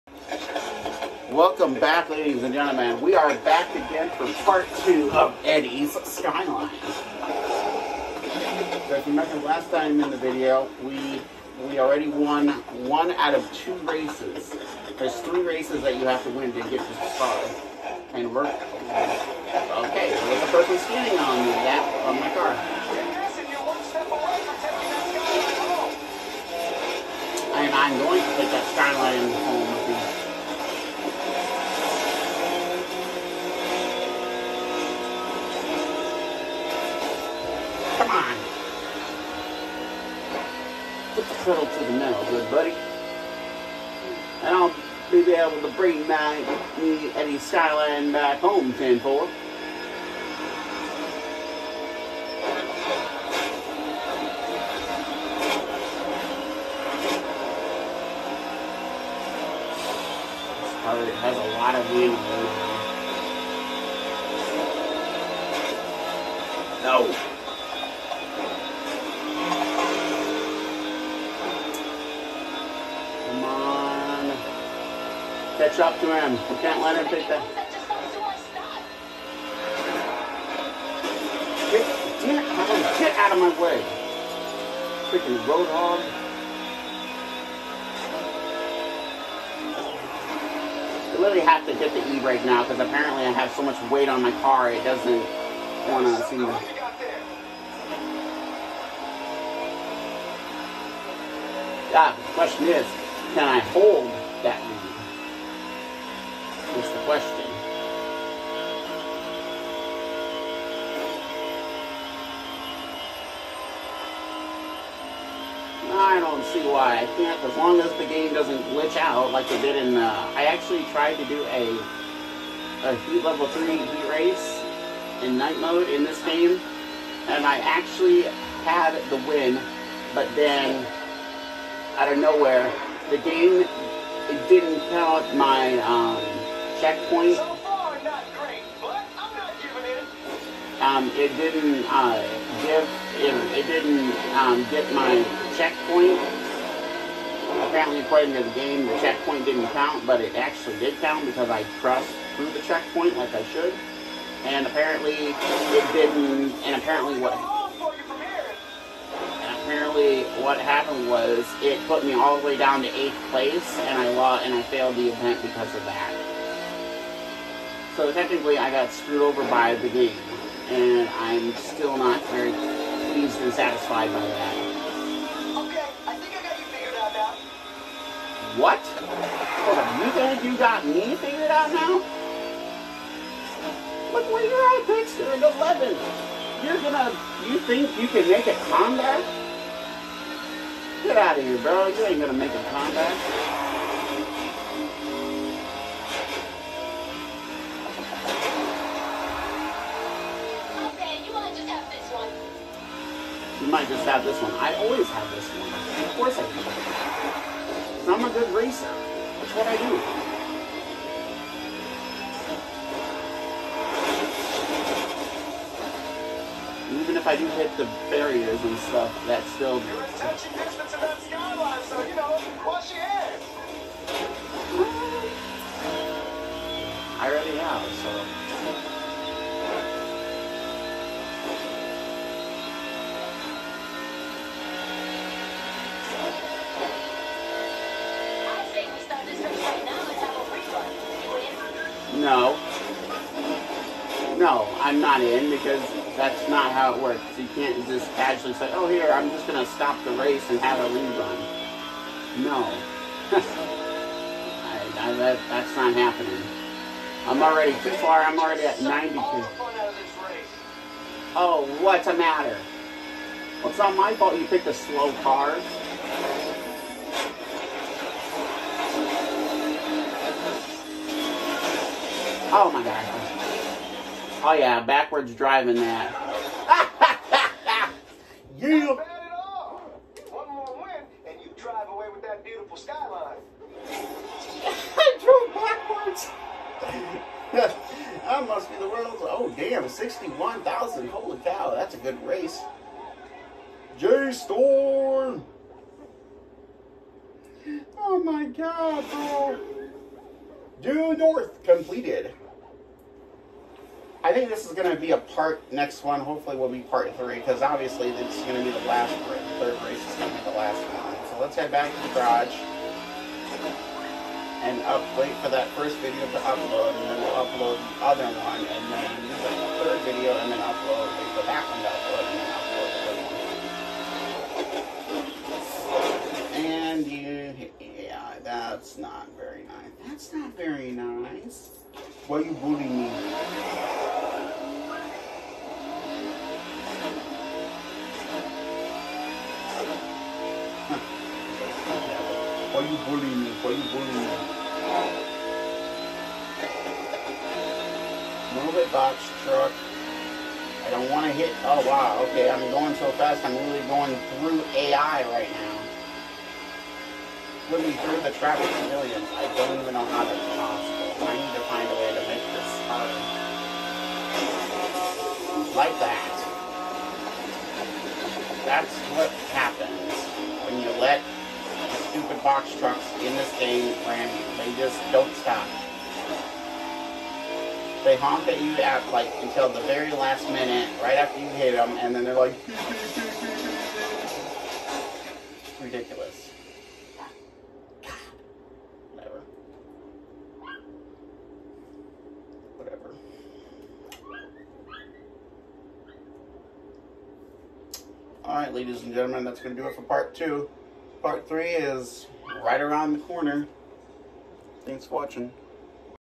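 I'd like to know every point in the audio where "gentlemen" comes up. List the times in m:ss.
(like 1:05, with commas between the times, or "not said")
0:02, 6:39.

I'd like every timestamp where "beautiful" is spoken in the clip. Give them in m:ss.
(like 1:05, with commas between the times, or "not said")
4:42.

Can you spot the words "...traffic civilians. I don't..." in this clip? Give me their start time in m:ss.
5:58.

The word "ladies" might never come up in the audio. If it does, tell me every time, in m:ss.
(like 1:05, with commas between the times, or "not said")
0:02, 6:38.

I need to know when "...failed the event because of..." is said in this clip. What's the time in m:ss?
2:44.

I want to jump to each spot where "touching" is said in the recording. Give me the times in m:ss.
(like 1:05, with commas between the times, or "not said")
3:40.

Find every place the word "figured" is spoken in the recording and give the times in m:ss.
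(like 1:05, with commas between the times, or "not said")
2:56, 3:01.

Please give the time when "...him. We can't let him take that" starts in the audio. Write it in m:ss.
1:16.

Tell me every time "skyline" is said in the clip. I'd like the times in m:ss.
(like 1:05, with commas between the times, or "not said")
0:06, 0:28, 0:47, 3:41, 4:42.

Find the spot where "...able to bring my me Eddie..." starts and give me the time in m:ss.
0:45.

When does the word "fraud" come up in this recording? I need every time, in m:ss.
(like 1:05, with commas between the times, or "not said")
not said.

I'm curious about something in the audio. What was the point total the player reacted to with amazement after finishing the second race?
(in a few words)
61,000.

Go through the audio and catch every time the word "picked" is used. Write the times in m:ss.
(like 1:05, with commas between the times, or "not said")
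4:24.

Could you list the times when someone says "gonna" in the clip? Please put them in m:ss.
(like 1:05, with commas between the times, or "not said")
3:06, 3:12.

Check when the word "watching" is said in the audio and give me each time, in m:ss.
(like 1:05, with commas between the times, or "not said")
6:45.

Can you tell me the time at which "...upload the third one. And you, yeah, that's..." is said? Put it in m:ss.
5:27.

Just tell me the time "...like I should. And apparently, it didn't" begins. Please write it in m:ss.
2:33.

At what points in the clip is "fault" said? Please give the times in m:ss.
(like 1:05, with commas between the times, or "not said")
4:24.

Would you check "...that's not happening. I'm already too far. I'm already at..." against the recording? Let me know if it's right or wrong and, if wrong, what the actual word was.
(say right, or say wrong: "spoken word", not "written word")
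right.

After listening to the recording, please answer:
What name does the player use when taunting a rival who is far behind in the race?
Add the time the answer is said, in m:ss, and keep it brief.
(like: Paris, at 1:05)
Dexter, at 3:04.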